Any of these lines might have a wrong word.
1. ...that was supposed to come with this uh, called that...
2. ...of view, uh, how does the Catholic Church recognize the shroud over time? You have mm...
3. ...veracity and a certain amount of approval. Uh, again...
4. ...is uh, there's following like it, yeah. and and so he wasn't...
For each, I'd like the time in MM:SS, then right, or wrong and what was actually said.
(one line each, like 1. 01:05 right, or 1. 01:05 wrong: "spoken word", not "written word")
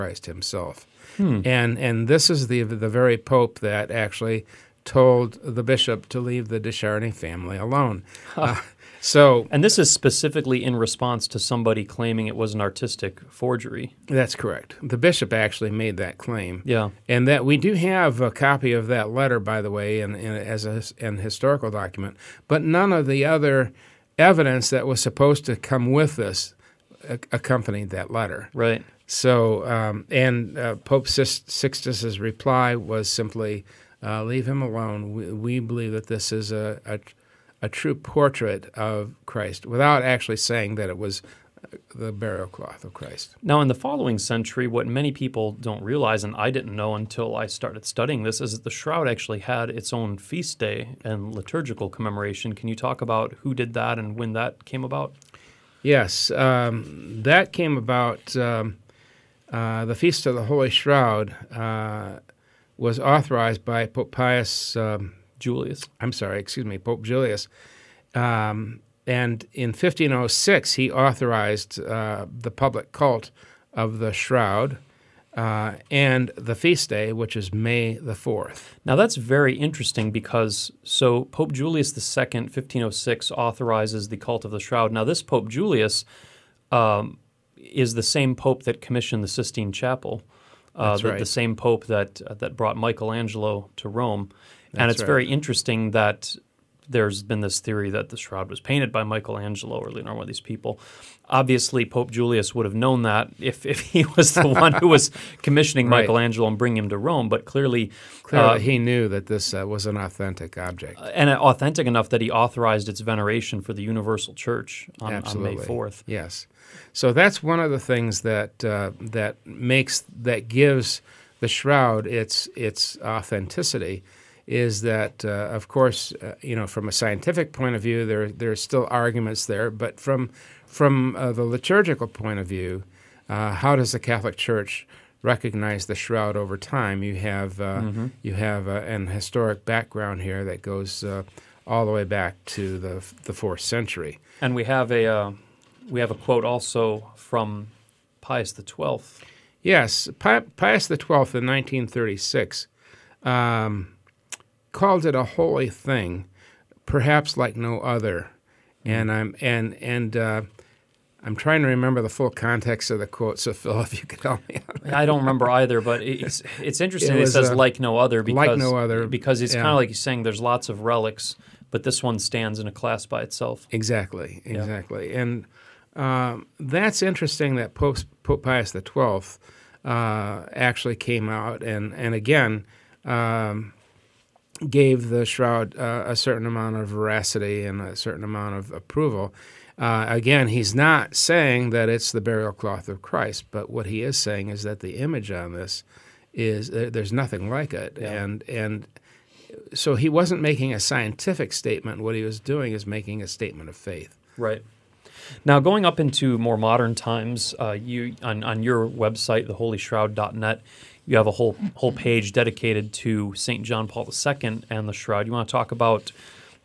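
1. 00:24 wrong: "accompanied", not "called"
2. 02:12 right
3. 03:06 right
4. 03:16 wrong: "nothing", not "following".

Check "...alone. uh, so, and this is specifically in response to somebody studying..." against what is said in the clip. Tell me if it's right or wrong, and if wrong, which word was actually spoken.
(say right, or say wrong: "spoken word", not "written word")
wrong: "claiming", not "studying".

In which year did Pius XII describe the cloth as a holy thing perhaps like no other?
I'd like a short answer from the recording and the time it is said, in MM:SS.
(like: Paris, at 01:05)
1936, at 02:31.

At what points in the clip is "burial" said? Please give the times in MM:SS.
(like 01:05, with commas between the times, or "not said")
00:42, 03:12.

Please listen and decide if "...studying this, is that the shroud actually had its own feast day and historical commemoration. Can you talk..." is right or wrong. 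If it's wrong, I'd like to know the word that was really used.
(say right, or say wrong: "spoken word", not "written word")
wrong: "liturgical", not "historical".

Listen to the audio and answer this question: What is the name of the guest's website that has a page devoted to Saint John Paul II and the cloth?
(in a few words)
theholyshroud.net.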